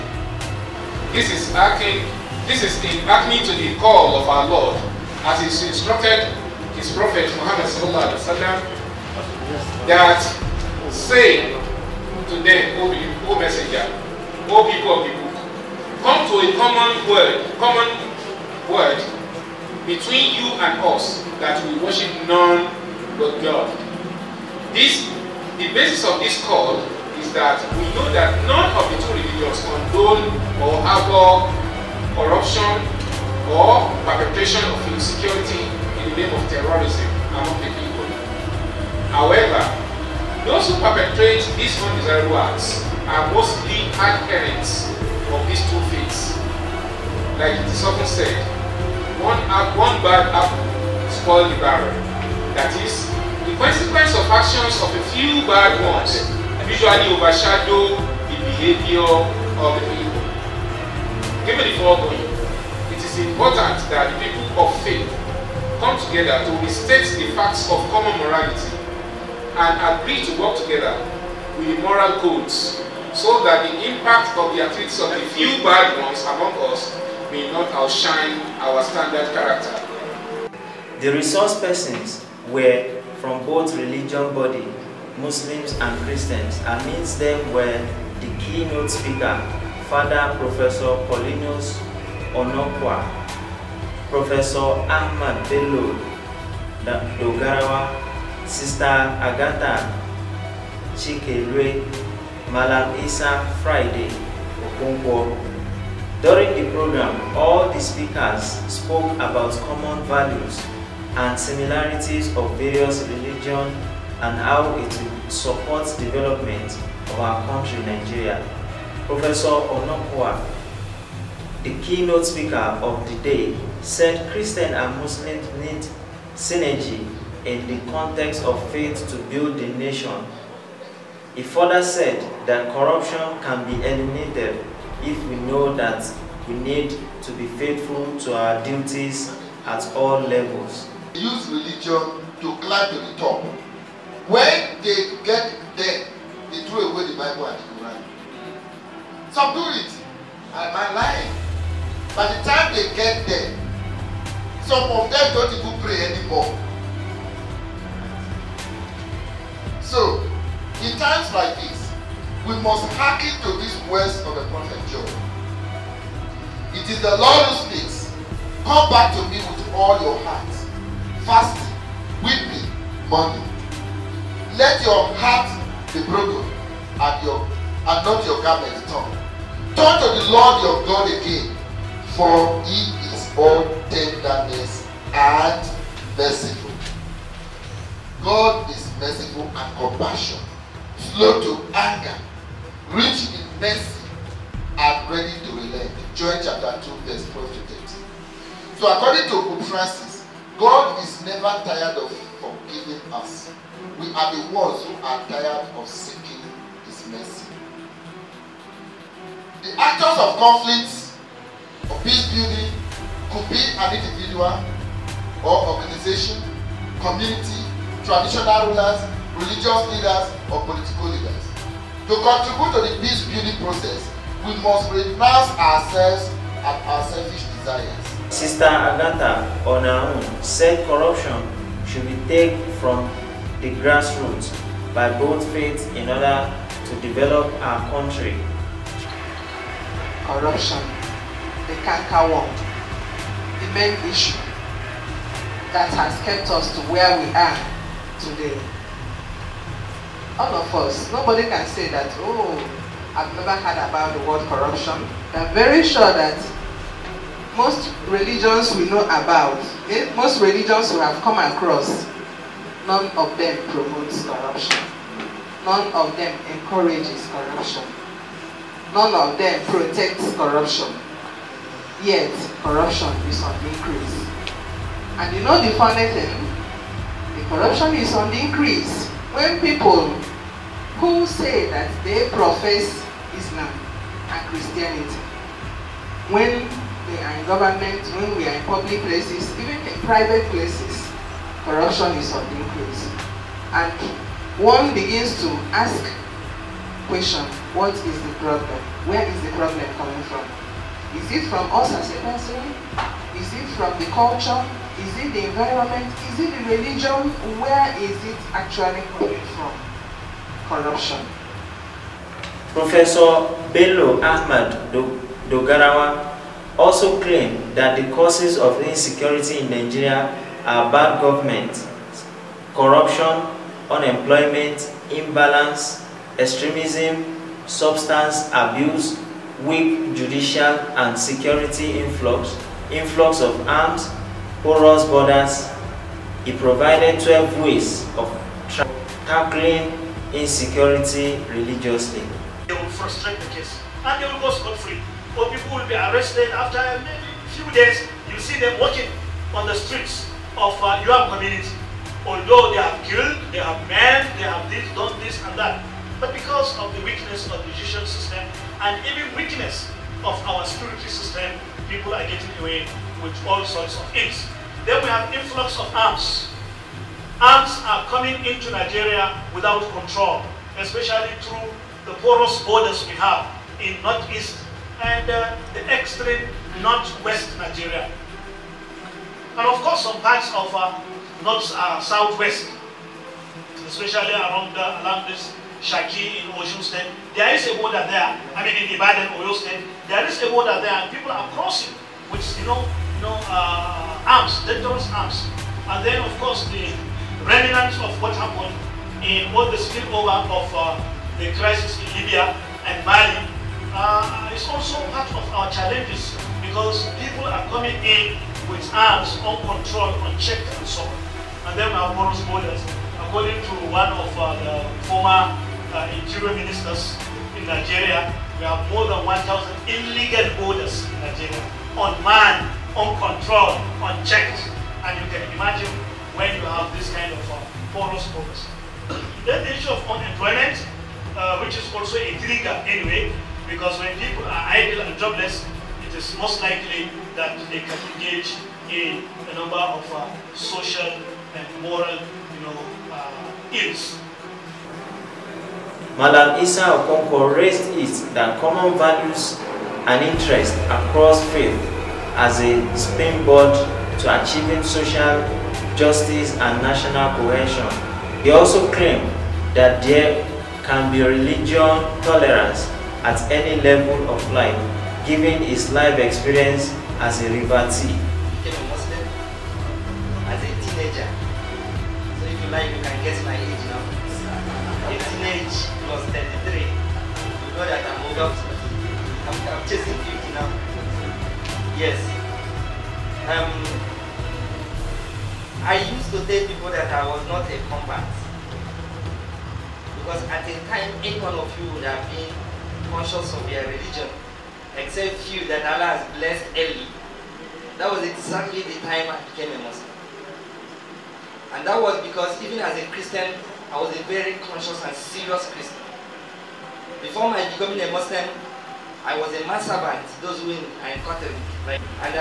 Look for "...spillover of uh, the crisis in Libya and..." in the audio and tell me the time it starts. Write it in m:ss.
6:39.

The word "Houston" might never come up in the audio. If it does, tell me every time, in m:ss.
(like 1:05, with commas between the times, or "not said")
not said.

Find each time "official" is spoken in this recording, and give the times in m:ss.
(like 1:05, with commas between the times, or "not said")
not said.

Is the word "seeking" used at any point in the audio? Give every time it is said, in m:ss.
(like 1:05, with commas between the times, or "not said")
3:25.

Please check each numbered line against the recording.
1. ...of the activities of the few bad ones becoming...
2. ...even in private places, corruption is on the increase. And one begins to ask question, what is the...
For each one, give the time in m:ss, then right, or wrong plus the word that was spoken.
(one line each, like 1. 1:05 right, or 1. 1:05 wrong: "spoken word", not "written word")
1. 1:14 wrong: "among", not "becoming"
2. 4:49 right.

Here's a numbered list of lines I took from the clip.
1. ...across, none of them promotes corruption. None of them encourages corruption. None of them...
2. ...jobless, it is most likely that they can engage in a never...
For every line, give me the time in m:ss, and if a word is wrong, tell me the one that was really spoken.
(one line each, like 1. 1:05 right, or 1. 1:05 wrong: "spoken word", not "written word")
1. 4:21 right
2. 7:15 wrong: "number", not "never".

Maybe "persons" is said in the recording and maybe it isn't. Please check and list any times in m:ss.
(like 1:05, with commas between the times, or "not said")
1:21, 5:02.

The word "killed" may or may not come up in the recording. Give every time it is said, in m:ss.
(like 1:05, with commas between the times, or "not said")
5:53.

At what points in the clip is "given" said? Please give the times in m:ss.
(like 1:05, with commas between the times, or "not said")
1:01, 7:45.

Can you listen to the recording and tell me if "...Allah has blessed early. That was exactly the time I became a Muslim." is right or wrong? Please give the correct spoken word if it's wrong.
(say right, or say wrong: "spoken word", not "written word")
right.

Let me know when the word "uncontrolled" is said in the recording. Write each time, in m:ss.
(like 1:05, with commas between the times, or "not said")
6:49, 7:02.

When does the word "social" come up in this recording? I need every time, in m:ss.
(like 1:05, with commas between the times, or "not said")
7:20, 7:34.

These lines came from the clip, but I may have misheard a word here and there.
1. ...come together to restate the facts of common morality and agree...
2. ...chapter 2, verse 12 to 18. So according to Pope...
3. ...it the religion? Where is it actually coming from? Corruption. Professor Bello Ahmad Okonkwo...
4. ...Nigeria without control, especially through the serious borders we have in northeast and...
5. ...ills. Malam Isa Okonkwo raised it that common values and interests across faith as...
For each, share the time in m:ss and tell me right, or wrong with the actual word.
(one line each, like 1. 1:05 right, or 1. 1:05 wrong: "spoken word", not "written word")
1. 1:05 right
2. 3:16 wrong: "13", not "18"
3. 5:06 wrong: "Dogarawa", not "Okonkwo"
4. 6:08 wrong: "porous", not "serious"
5. 7:23 right.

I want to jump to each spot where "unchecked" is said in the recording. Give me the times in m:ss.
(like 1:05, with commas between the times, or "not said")
6:50, 7:03.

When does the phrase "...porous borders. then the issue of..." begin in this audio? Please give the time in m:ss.
7:07.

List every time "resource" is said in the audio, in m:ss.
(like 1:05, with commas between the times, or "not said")
1:21.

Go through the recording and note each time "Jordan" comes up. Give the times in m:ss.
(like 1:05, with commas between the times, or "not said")
not said.